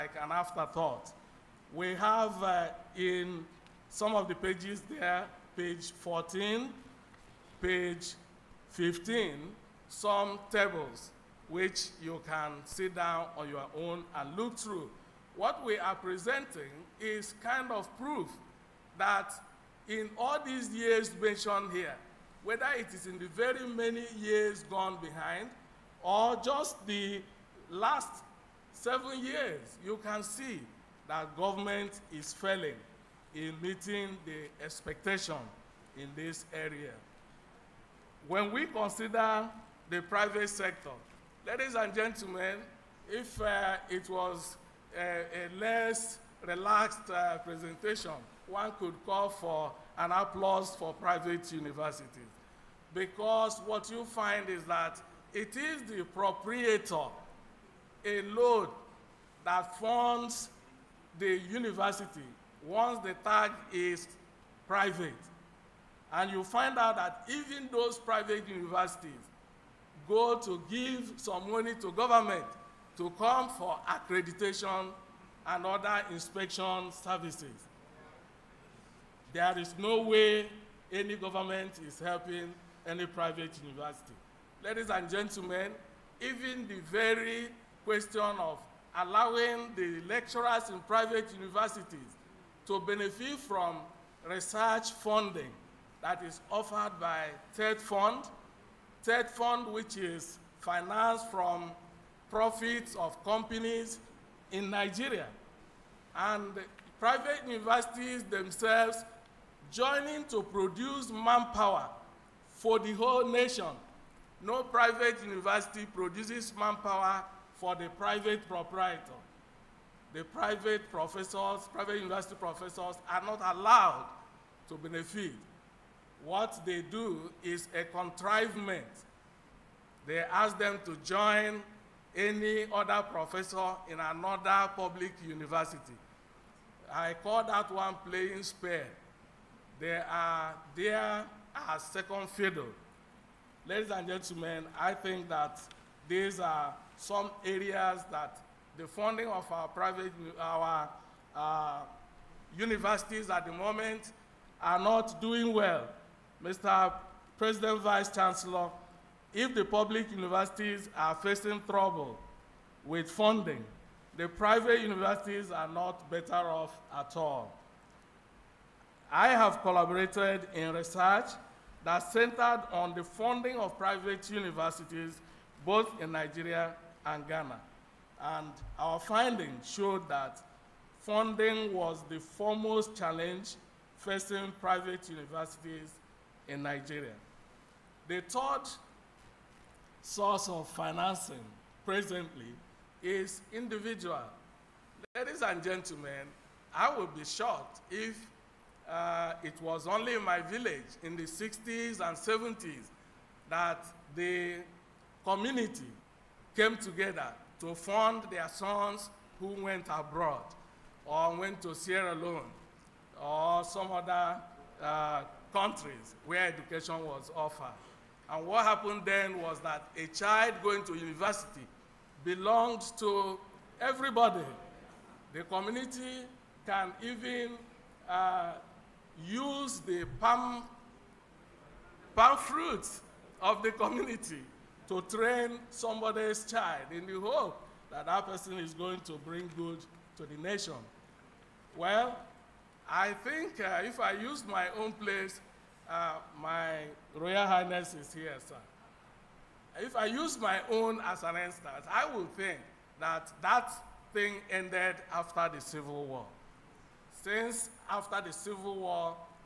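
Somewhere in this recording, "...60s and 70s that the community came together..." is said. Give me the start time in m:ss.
3:21.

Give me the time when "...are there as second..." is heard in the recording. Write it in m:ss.
2:20.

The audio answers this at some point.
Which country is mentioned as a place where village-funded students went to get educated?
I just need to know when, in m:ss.
3:31.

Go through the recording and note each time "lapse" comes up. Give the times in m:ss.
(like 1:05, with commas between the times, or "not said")
not said.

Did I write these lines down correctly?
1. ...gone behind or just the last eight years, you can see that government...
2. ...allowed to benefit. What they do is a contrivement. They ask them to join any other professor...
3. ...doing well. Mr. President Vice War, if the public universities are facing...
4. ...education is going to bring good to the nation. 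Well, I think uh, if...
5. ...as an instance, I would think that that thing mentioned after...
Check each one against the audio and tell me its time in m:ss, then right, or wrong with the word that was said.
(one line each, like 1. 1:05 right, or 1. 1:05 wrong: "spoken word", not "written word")
1. 0:24 wrong: "seven", not "eight"
2. 2:03 right
3. 2:35 wrong: "Chancellor", not "War"
4. 3:58 wrong: "person", not "education"
5. 4:11 wrong: "ended", not "mentioned".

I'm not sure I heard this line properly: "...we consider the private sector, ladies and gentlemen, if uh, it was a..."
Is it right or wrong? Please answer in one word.
right.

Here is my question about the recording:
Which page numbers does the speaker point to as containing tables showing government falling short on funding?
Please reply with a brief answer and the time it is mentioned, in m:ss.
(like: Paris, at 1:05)
14 and 15, at 0:05.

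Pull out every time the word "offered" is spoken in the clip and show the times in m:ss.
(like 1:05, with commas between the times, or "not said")
1:36, 3:37.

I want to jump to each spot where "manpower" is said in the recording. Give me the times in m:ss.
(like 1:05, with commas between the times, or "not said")
1:51, 1:56.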